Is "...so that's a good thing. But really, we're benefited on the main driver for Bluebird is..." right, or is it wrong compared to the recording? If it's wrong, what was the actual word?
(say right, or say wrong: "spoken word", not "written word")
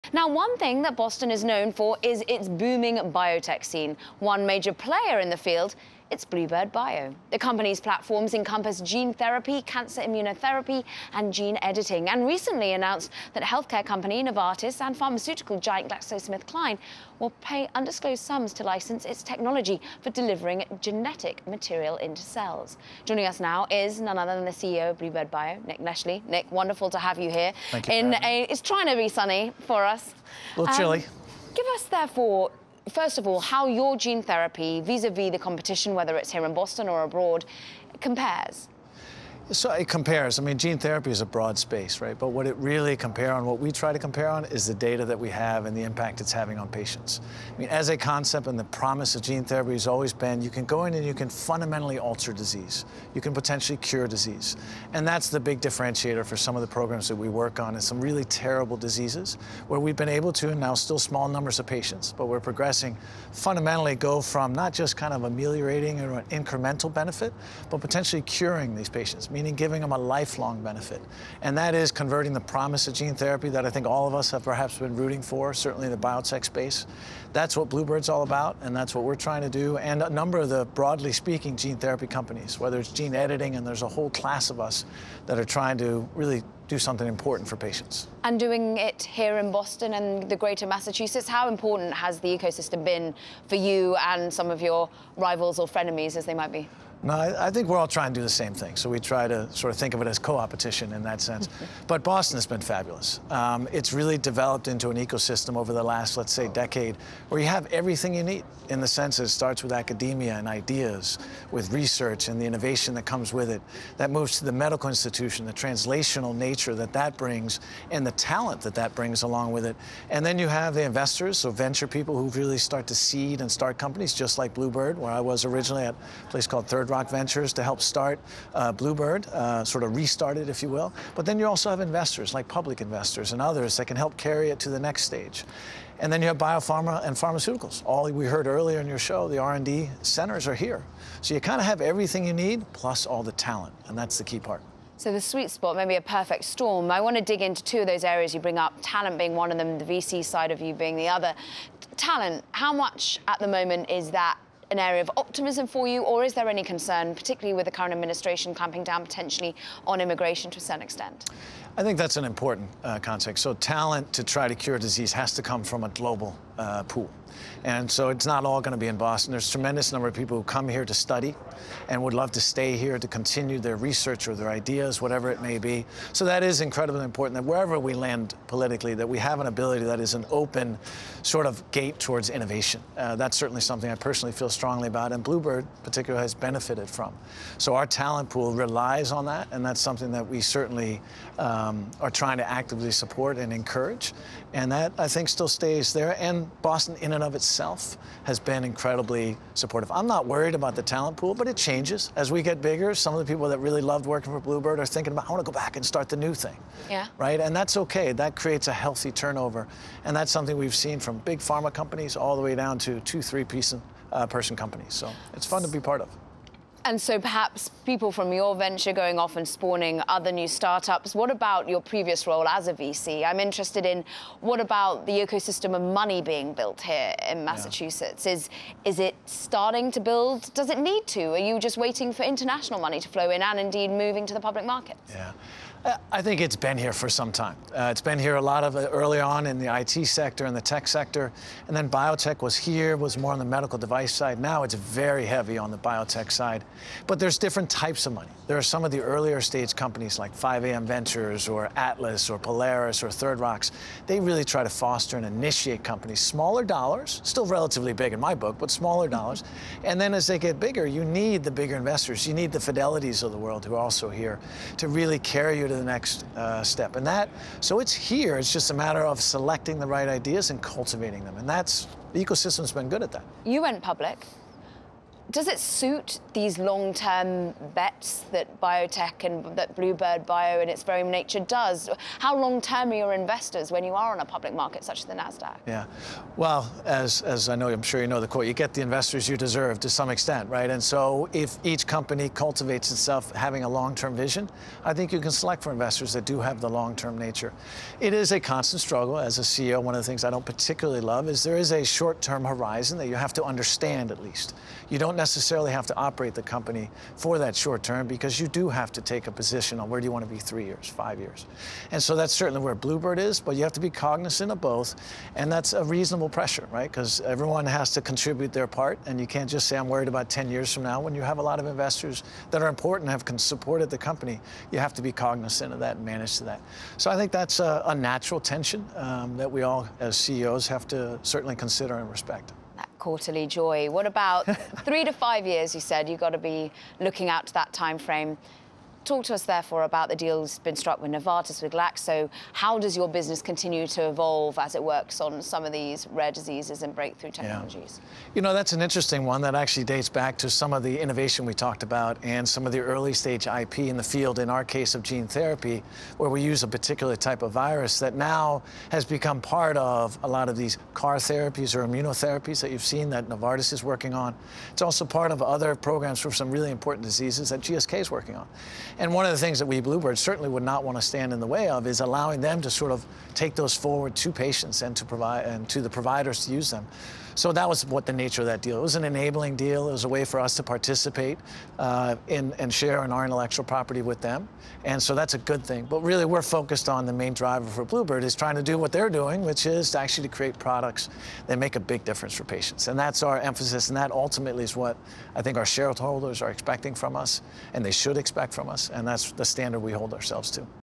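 wrong: "focused", not "benefited".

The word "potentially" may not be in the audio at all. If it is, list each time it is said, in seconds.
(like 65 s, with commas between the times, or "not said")
53 s, 67 s, 159 s.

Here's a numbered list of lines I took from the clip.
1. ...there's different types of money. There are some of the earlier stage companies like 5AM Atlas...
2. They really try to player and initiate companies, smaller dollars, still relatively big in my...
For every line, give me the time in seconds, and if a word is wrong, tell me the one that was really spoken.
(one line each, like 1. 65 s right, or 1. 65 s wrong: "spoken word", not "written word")
1. 247 s wrong: "Ventures", not "Atlas"
2. 254 s wrong: "foster", not "player".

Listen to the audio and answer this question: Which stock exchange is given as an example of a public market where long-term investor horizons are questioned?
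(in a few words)
Nasdaq.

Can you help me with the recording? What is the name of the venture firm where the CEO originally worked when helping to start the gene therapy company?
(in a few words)
Third Rock Ventures.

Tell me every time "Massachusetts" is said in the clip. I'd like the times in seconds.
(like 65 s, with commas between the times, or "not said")
90 s, 227 s.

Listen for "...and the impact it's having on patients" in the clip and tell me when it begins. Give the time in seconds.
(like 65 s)
45 s.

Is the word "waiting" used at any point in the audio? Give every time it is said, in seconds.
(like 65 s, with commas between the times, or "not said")
231 s.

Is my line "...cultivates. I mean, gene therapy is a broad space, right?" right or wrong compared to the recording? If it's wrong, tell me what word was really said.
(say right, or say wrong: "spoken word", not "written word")
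wrong: "compares", not "cultivates".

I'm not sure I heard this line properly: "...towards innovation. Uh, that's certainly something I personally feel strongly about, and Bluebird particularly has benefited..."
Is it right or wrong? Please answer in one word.
right.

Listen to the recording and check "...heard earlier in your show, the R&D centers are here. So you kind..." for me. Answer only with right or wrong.
right.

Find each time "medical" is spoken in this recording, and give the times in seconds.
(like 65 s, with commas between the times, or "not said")
114 s, 243 s.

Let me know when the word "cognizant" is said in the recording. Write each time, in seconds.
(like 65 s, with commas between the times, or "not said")
313 s, 325 s.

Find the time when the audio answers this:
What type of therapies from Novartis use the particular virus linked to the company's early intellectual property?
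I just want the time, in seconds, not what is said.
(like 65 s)
360 s.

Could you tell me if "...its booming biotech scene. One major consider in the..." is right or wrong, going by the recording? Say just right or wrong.
wrong.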